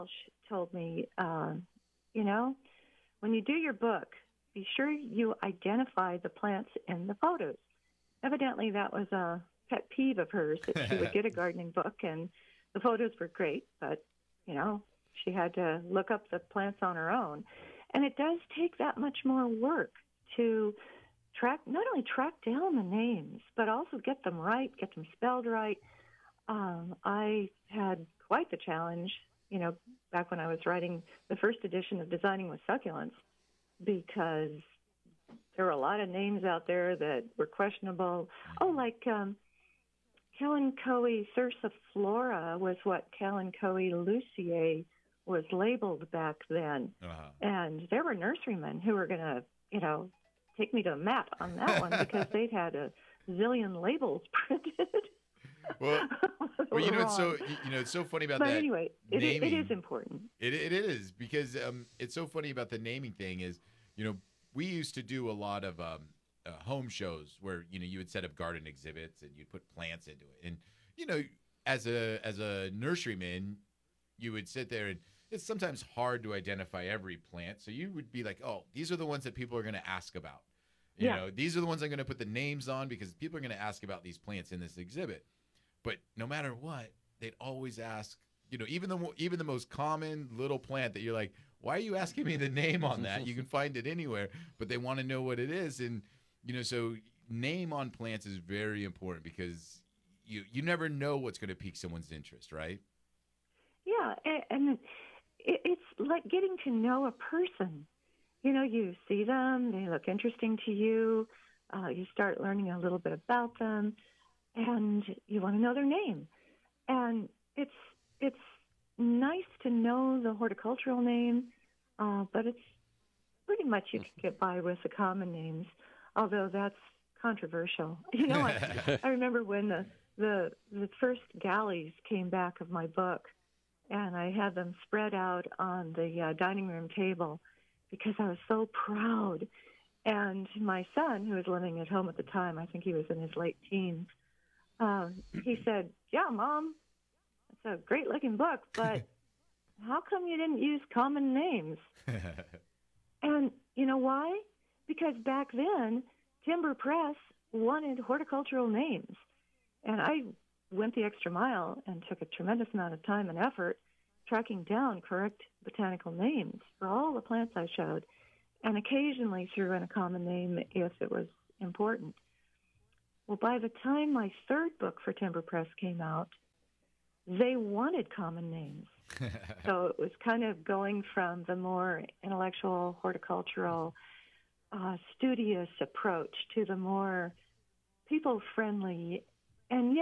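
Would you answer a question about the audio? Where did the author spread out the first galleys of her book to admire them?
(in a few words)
dining room table.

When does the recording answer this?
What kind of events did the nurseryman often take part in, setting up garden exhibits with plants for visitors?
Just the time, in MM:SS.
01:06.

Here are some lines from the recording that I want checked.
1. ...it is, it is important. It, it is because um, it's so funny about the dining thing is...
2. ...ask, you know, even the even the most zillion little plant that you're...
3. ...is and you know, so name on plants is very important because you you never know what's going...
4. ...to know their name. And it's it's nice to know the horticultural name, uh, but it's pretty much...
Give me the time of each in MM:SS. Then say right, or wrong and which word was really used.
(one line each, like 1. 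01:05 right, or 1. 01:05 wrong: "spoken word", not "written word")
1. 00:59 wrong: "naming", not "dining"
2. 01:27 wrong: "common", not "zillion"
3. 01:35 right
4. 01:55 right.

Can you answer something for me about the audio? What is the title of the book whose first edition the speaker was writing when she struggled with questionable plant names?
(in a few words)
Designing with Succulents.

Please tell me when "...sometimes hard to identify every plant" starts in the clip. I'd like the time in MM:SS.
01:15.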